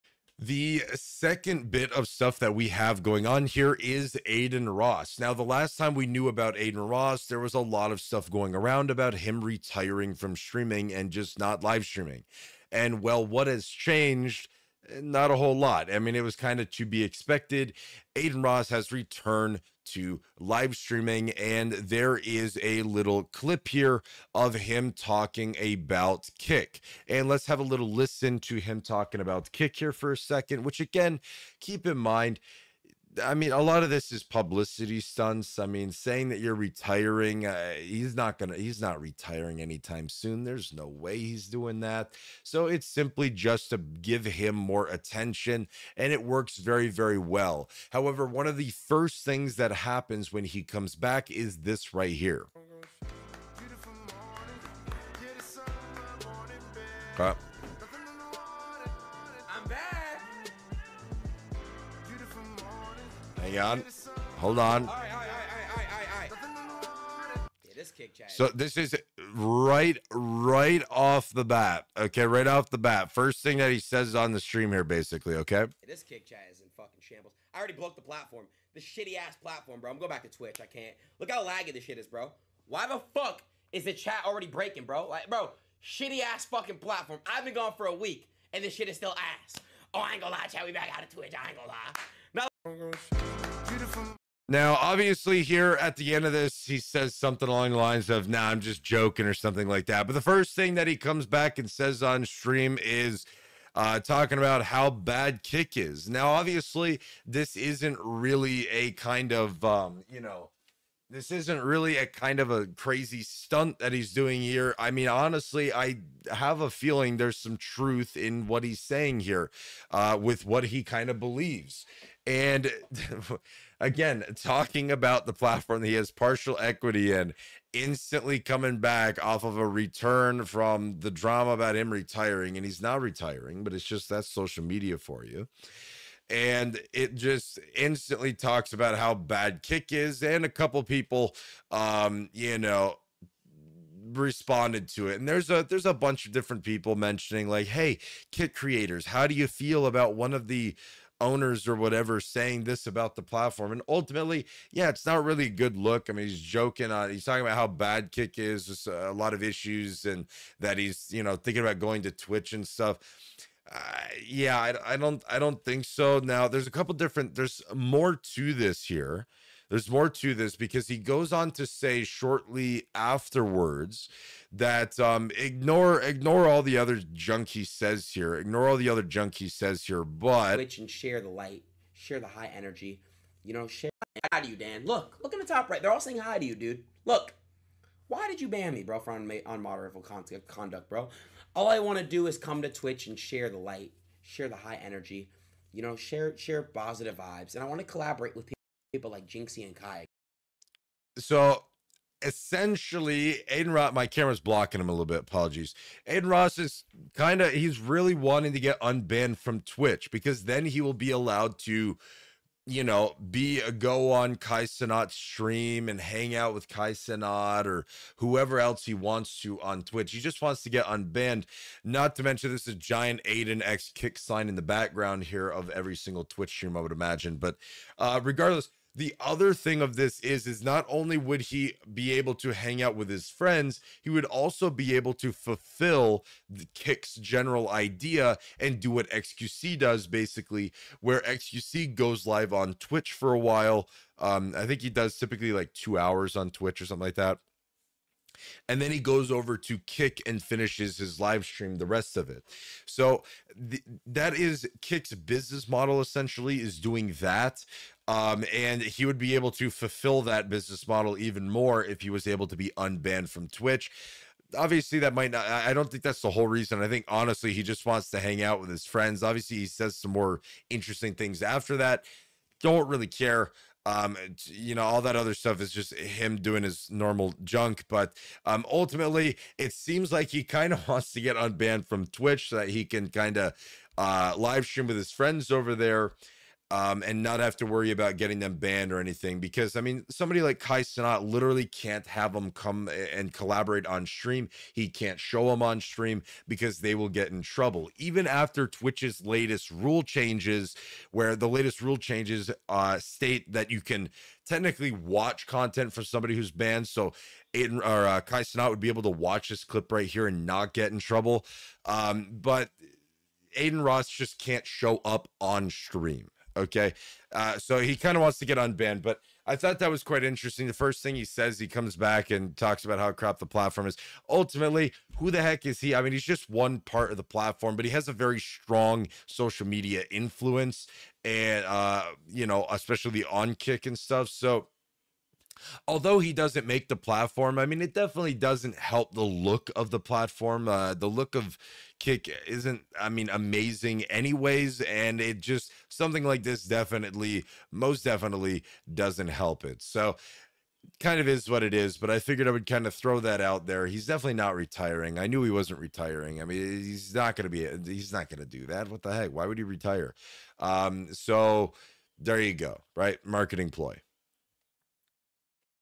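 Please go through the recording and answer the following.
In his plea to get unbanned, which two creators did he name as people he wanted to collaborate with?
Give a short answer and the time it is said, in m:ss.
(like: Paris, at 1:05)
Jynxzi and Kai, at 3:19.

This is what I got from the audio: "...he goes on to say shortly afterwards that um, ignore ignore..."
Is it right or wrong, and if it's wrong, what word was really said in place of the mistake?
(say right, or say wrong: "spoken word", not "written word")
right.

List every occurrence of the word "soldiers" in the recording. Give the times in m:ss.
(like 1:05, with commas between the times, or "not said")
not said.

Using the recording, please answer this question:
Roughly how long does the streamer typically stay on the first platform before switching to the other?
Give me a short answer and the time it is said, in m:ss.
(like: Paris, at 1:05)
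2 hours, at 4:05.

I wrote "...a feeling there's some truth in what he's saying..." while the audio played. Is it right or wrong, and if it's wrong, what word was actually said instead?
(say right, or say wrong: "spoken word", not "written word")
right.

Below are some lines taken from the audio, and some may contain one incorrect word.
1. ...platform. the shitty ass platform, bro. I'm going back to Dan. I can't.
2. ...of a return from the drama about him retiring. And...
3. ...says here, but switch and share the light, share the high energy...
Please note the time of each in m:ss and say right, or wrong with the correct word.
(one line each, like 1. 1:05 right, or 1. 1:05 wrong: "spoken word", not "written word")
1. 1:18 wrong: "Twitch", not "Dan"
2. 2:09 right
3. 2:59 right.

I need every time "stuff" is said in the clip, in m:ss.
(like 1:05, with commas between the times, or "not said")
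0:02, 0:08, 2:42, 4:35, 5:33.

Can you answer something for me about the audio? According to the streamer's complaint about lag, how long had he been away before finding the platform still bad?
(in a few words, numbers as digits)
a week.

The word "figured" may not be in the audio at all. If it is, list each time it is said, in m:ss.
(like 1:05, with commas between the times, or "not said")
5:52.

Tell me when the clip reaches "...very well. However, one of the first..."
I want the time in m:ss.
0:46.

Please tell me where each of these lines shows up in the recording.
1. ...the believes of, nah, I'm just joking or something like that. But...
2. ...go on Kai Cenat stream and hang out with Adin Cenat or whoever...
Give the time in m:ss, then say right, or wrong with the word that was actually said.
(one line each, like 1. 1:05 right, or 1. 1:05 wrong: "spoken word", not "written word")
1. 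1:37 wrong: "lines", not "believes"
2. 3:33 wrong: "Kai", not "Adin".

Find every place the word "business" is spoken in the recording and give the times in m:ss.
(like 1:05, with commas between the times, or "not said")
4:15, 4:20.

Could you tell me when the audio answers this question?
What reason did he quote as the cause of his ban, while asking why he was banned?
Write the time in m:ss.
3:09.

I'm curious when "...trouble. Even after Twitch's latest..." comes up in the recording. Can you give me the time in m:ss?
4:57.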